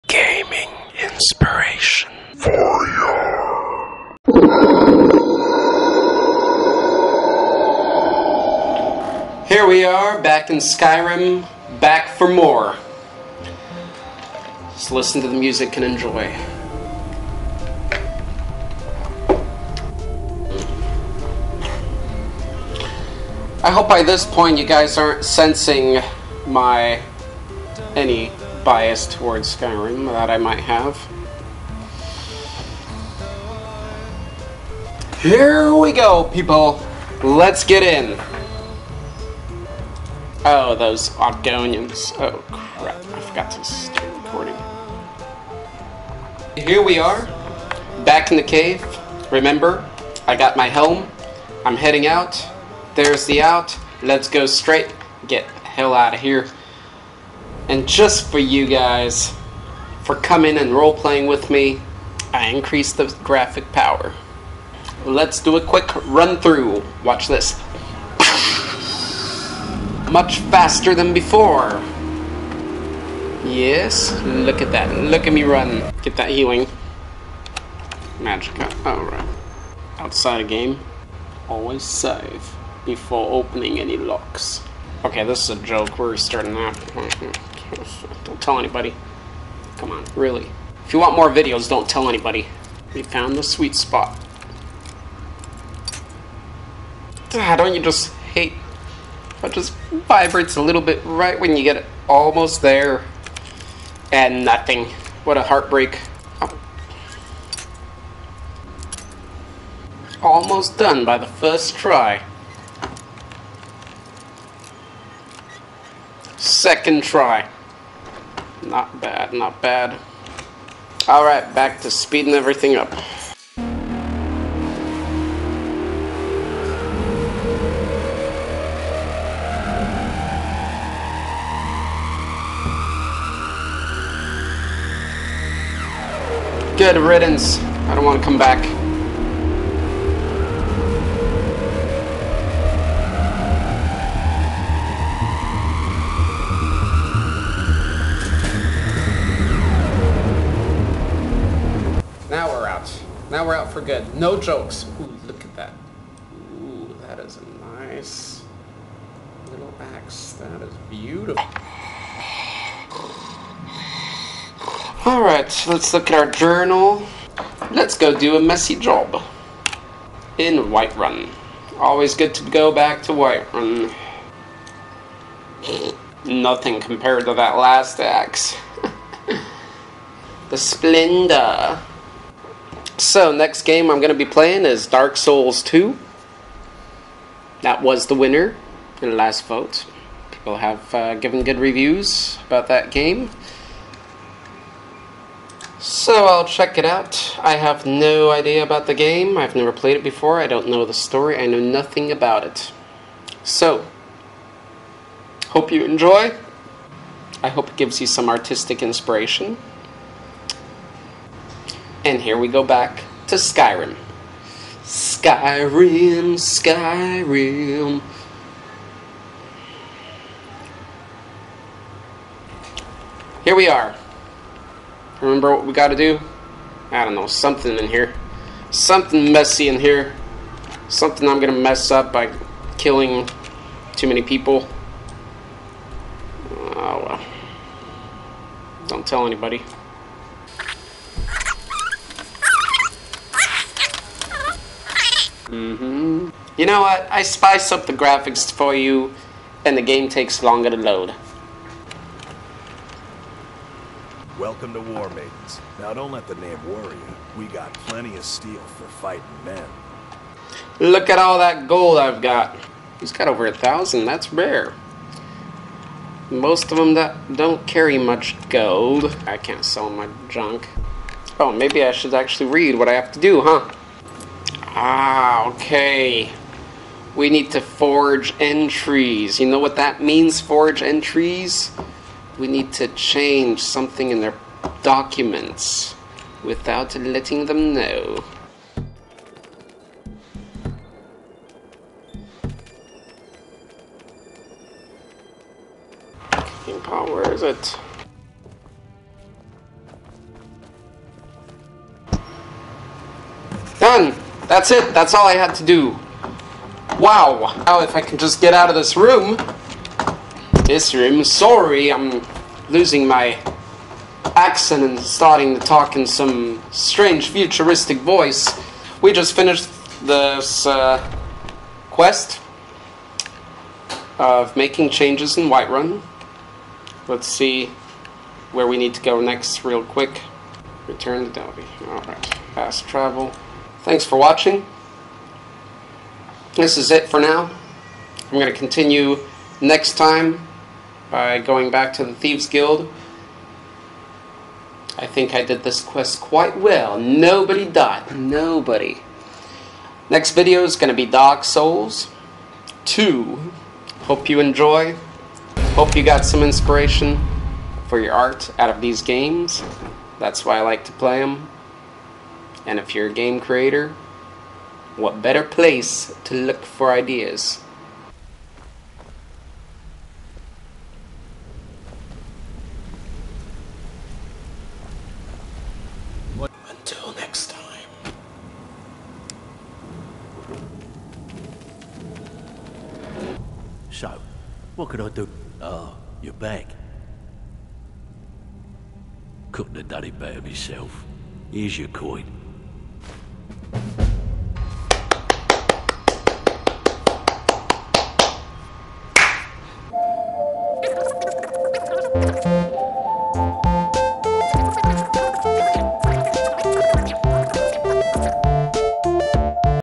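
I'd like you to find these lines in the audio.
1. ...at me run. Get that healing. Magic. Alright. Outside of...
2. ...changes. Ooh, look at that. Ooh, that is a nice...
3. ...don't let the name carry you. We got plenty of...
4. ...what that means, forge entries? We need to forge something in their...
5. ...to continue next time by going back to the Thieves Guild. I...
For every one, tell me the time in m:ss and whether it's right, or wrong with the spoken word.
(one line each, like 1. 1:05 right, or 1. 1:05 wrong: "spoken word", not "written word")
1. 1:15 right
2. 2:34 wrong: "jokes", not "changes"
3. 4:15 wrong: "worry", not "carry"
4. 4:39 wrong: "change", not "forge"
5. 5:38 right.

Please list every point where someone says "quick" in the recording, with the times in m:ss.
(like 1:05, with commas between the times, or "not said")
1:05, 5:29.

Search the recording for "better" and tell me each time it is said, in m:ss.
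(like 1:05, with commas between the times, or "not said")
6:05, 6:30.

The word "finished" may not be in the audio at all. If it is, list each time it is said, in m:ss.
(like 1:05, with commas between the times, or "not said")
5:19.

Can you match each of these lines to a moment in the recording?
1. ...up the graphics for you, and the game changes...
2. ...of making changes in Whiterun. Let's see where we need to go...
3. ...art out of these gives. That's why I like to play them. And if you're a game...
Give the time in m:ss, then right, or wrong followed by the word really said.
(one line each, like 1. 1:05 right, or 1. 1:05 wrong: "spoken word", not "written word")
1. 4:07 wrong: "takes", not "changes"
2. 5:24 right
3. 5:58 wrong: "games", not "gives".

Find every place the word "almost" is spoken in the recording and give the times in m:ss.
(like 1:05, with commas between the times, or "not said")
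1:42, 1:50.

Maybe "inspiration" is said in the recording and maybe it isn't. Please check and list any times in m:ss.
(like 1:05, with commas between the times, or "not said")
0:01, 3:28, 5:56.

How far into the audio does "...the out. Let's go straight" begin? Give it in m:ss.
0:53.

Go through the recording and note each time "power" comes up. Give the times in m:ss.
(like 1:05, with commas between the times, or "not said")
1:03.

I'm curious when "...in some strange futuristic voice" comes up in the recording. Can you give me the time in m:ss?
5:15.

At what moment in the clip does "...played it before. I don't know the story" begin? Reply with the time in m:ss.
3:19.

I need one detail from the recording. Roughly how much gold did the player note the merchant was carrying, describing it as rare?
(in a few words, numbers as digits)
over 1000.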